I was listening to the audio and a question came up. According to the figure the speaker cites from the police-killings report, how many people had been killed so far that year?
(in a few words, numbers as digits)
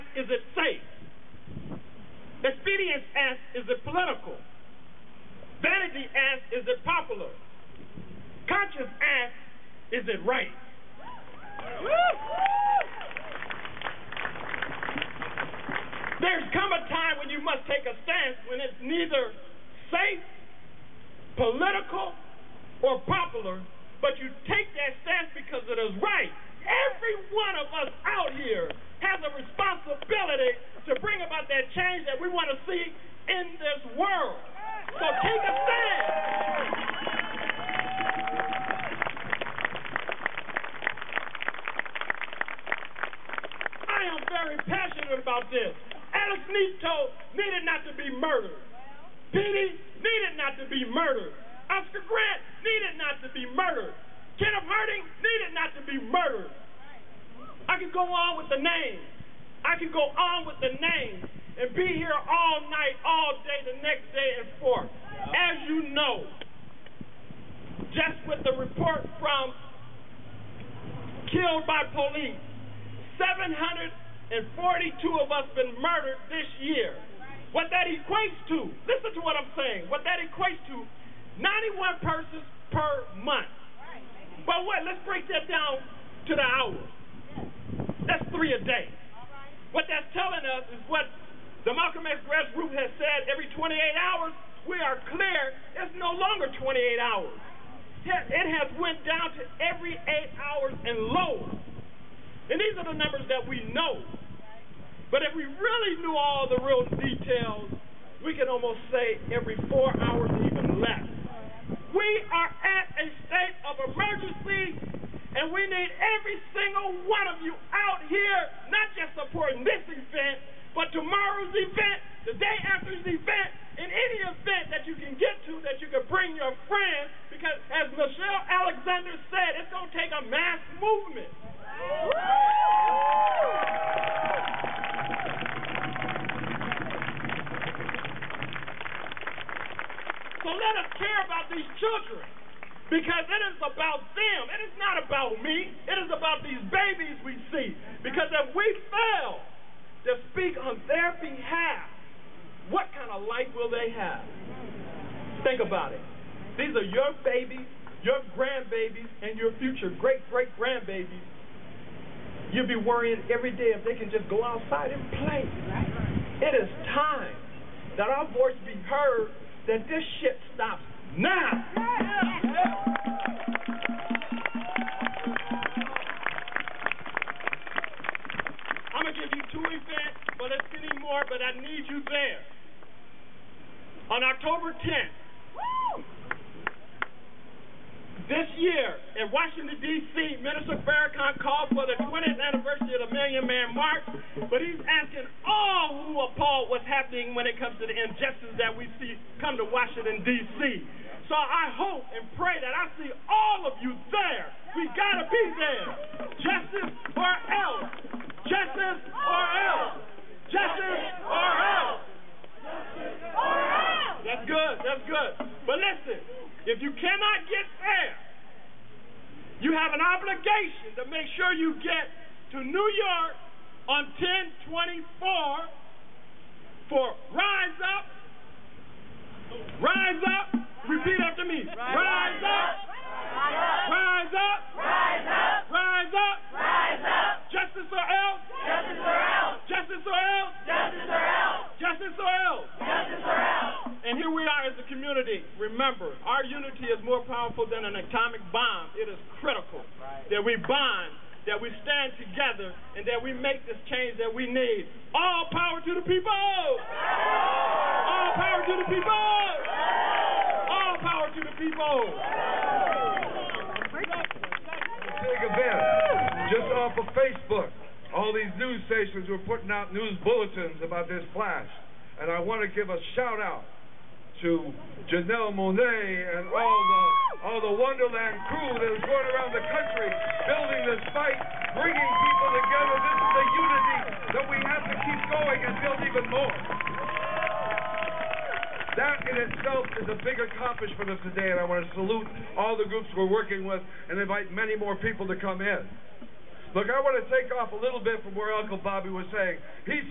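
742.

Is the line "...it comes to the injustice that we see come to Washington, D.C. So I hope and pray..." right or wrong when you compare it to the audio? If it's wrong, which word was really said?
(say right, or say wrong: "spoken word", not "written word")
right.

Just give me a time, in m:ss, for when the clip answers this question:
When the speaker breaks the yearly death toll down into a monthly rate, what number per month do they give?
1:21.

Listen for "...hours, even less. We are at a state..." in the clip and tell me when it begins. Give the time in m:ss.
1:50.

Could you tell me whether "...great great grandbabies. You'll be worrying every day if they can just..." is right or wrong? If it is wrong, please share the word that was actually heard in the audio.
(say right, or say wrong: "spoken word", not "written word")
right.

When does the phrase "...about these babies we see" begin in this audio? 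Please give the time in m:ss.
2:26.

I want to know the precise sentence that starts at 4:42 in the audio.
This is the unity that we have to keep going and build even more.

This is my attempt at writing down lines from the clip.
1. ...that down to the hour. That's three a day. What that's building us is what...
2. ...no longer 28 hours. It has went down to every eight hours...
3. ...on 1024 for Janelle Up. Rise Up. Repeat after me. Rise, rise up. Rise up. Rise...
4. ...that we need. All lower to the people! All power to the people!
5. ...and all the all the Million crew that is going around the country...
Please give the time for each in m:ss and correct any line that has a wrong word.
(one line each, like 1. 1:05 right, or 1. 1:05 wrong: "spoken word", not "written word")
1. 1:25 wrong: "telling", not "building"
2. 1:35 right
3. 3:43 wrong: "Rise", not "Janelle"
4. 4:14 wrong: "power", not "lower"
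5. 4:36 wrong: "Wondaland", not "Million".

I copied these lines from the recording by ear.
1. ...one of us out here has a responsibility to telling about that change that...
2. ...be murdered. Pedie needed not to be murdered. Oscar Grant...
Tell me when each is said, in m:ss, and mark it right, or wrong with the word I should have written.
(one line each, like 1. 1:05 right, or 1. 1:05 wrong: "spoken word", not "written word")
1. 0:27 wrong: "bring", not "telling"
2. 0:47 right.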